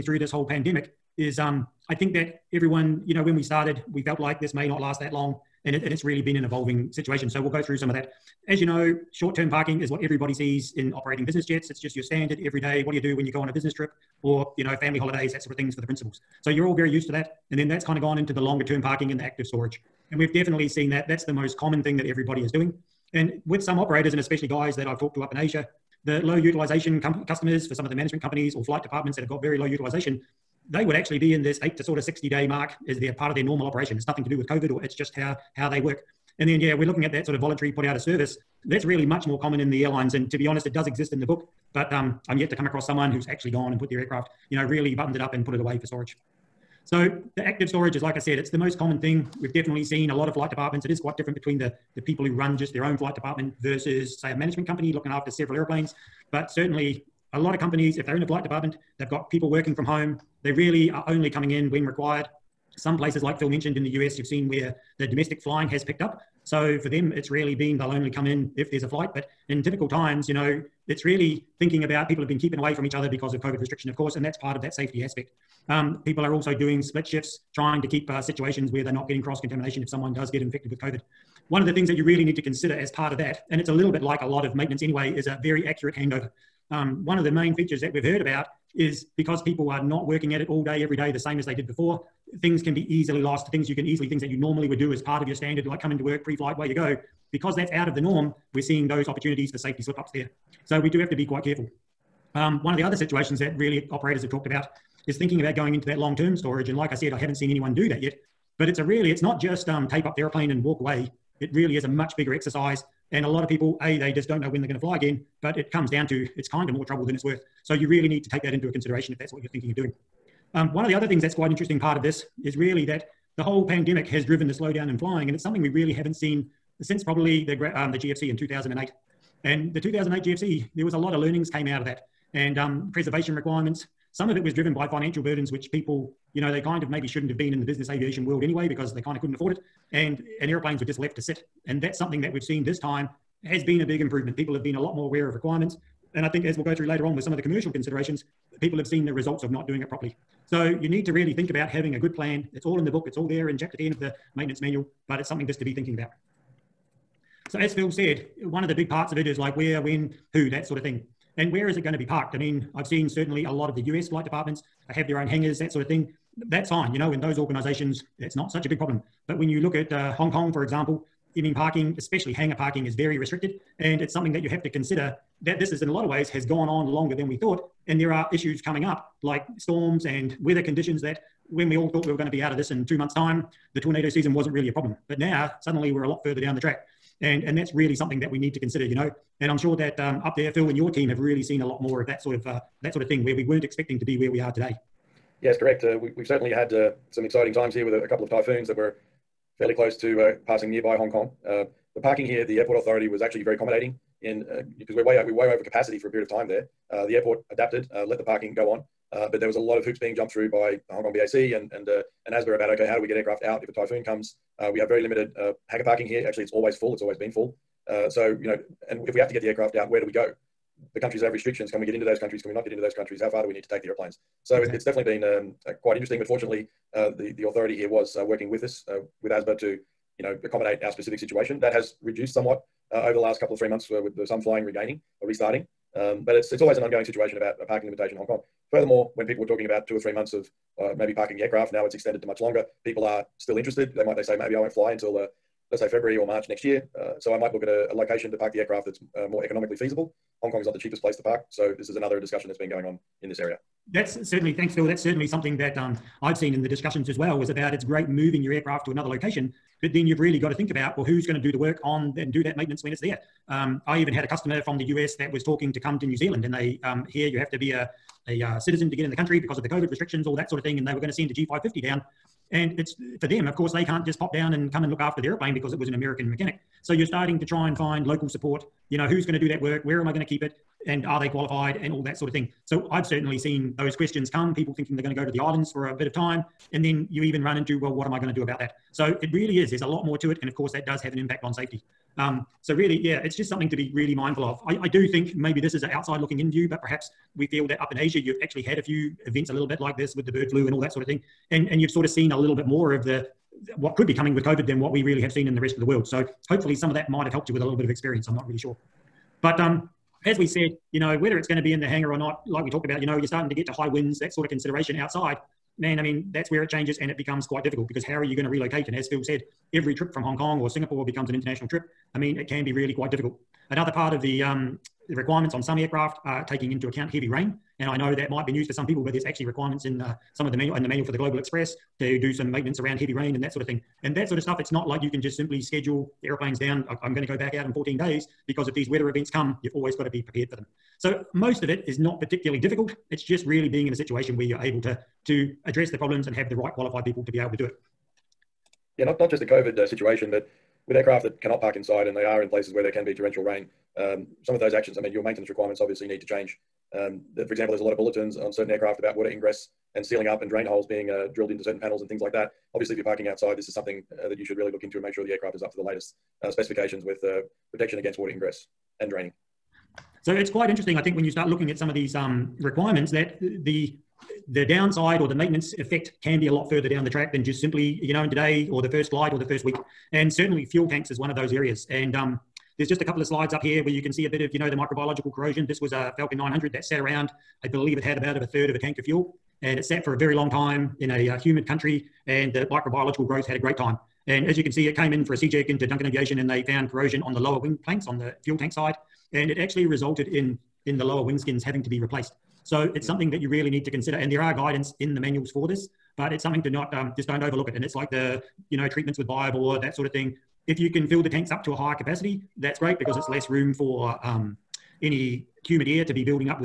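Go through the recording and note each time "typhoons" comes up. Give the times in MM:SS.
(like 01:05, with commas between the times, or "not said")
03:18, 03:33.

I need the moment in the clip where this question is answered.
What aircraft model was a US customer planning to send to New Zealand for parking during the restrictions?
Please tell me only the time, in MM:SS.
04:31.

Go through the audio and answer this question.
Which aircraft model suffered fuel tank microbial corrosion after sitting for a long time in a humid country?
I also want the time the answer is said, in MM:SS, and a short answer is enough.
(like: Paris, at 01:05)
Falcon 900, at 06:26.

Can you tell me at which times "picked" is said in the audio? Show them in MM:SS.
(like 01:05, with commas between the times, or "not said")
01:05.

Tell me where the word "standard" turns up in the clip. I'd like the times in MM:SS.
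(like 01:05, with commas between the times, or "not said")
00:12, 01:35.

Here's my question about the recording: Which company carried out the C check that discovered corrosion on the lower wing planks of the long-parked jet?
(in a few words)
Duncan Aviation.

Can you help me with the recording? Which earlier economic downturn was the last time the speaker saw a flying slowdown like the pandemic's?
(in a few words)
2008 GFC.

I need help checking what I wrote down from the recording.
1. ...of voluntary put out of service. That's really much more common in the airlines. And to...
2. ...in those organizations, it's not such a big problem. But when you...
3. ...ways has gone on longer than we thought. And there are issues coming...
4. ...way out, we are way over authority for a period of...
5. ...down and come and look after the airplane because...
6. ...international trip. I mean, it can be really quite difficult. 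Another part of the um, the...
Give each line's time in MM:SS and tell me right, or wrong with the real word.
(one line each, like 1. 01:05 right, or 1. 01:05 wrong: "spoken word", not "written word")
1. 00:37 right
2. 02:47 right
3. 02:56 right
4. 03:25 wrong: "capacity", not "authority"
5. 04:34 right
6. 05:21 right.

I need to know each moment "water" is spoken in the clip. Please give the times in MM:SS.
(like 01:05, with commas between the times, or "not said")
05:59, 06:08.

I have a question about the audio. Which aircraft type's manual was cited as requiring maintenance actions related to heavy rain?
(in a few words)
Global Express.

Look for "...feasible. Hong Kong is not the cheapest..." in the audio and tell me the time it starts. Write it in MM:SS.
04:09.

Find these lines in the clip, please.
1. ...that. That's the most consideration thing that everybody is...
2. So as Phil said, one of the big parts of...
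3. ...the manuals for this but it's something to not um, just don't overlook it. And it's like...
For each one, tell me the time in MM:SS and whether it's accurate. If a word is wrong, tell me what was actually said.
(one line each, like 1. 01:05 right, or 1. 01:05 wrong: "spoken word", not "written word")
1. 00:20 wrong: "common", not "consideration"
2. 02:37 right
3. 06:45 right.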